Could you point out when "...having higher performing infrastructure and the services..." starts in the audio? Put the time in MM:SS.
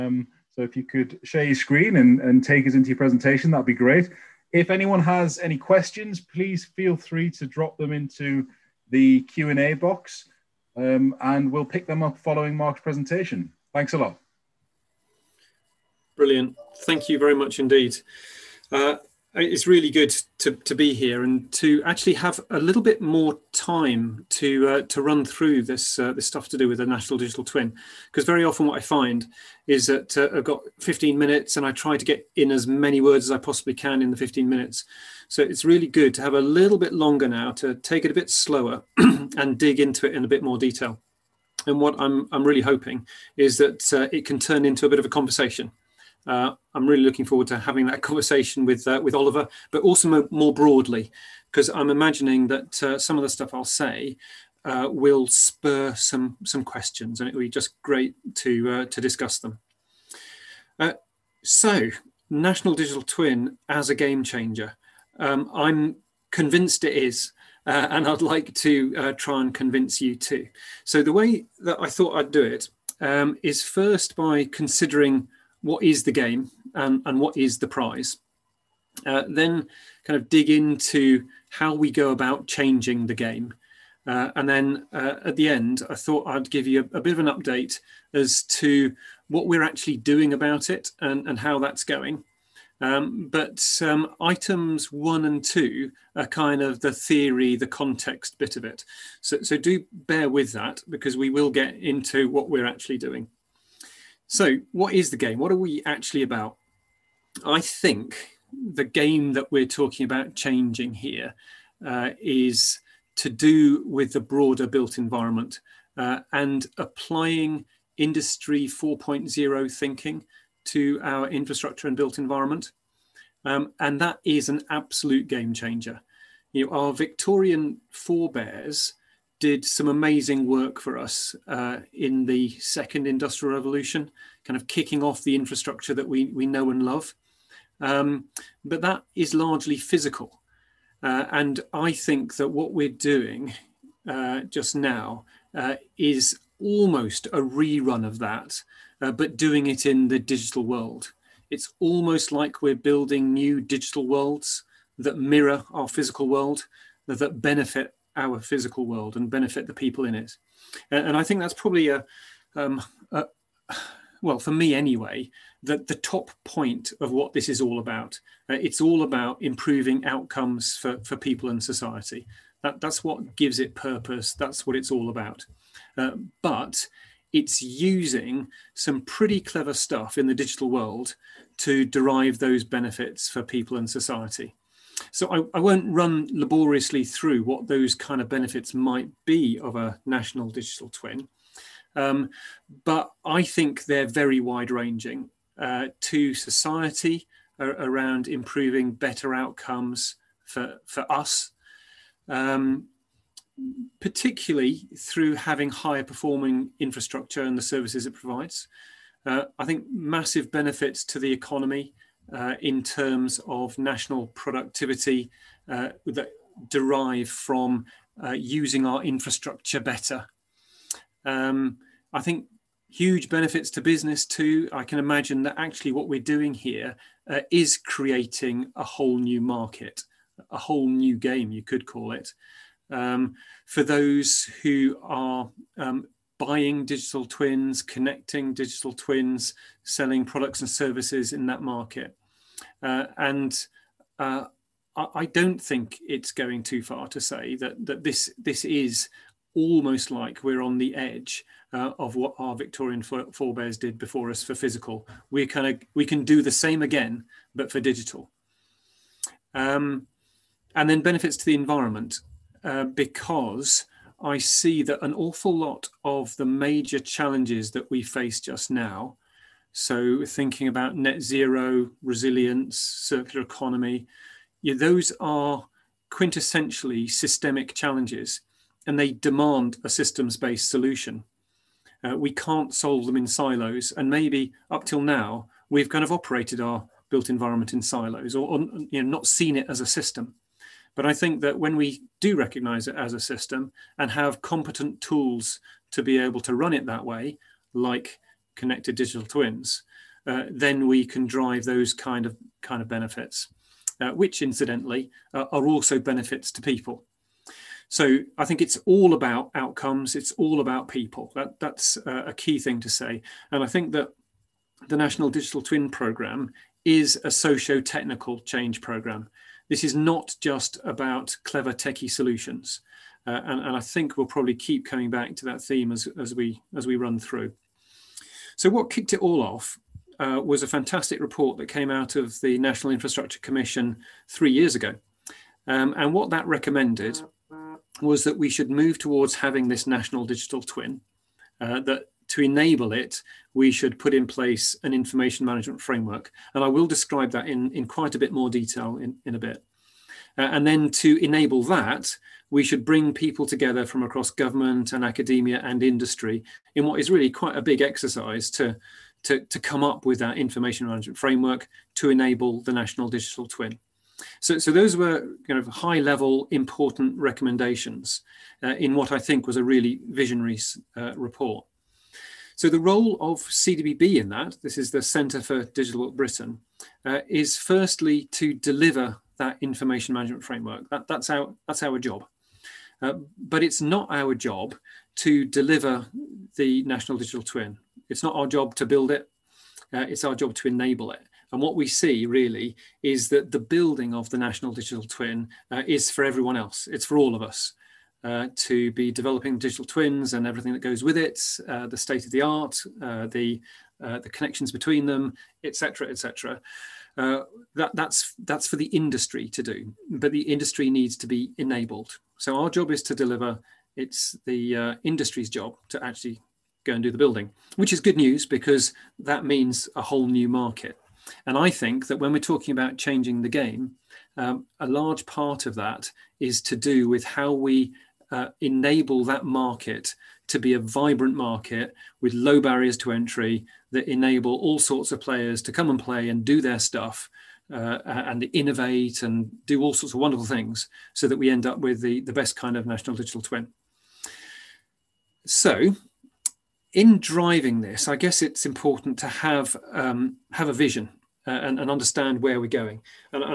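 03:25.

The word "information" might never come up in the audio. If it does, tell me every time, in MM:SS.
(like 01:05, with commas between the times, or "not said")
05:44, 06:00, 06:19.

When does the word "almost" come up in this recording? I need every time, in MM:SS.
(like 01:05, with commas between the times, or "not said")
02:26, 02:31, 04:09.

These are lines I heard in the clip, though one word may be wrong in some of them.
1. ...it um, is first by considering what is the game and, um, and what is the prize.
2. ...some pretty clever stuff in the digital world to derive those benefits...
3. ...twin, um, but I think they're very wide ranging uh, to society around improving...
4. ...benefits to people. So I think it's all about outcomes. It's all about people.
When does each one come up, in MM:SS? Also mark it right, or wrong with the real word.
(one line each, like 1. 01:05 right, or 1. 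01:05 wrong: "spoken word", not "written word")
1. 01:12 right
2. 02:58 right
3. 03:10 right
4. 05:05 right.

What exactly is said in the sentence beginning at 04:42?
Uh, we can't solve them in silos.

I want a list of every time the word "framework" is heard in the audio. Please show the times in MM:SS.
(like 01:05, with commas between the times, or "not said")
05:45, 06:01, 06:20.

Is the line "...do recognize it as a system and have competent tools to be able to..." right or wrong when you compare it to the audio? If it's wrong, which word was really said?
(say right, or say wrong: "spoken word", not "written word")
right.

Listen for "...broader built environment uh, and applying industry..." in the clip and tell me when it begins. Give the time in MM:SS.
01:54.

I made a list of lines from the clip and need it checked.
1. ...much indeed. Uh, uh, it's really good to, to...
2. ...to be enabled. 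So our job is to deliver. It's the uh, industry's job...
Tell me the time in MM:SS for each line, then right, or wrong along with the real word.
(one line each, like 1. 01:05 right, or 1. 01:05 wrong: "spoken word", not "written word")
1. 00:17 right
2. 06:51 right.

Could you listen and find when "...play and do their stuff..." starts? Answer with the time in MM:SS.
07:15.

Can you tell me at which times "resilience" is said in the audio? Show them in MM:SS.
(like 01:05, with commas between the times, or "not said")
04:32.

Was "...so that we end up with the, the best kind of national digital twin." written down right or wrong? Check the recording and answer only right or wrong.
right.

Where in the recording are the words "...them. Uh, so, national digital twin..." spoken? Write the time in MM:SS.
00:59.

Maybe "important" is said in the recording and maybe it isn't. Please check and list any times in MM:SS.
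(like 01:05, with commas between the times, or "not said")
06:06, 07:28.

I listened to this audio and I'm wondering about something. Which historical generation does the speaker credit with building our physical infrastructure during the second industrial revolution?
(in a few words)
Victorian forebears.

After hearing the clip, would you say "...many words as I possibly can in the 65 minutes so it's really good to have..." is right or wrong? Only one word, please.
wrong.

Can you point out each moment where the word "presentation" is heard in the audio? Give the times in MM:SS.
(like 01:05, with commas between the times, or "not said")
00:02, 00:12.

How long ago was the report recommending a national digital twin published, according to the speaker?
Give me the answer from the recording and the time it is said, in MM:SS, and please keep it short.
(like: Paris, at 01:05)
3 years ago, at 05:34.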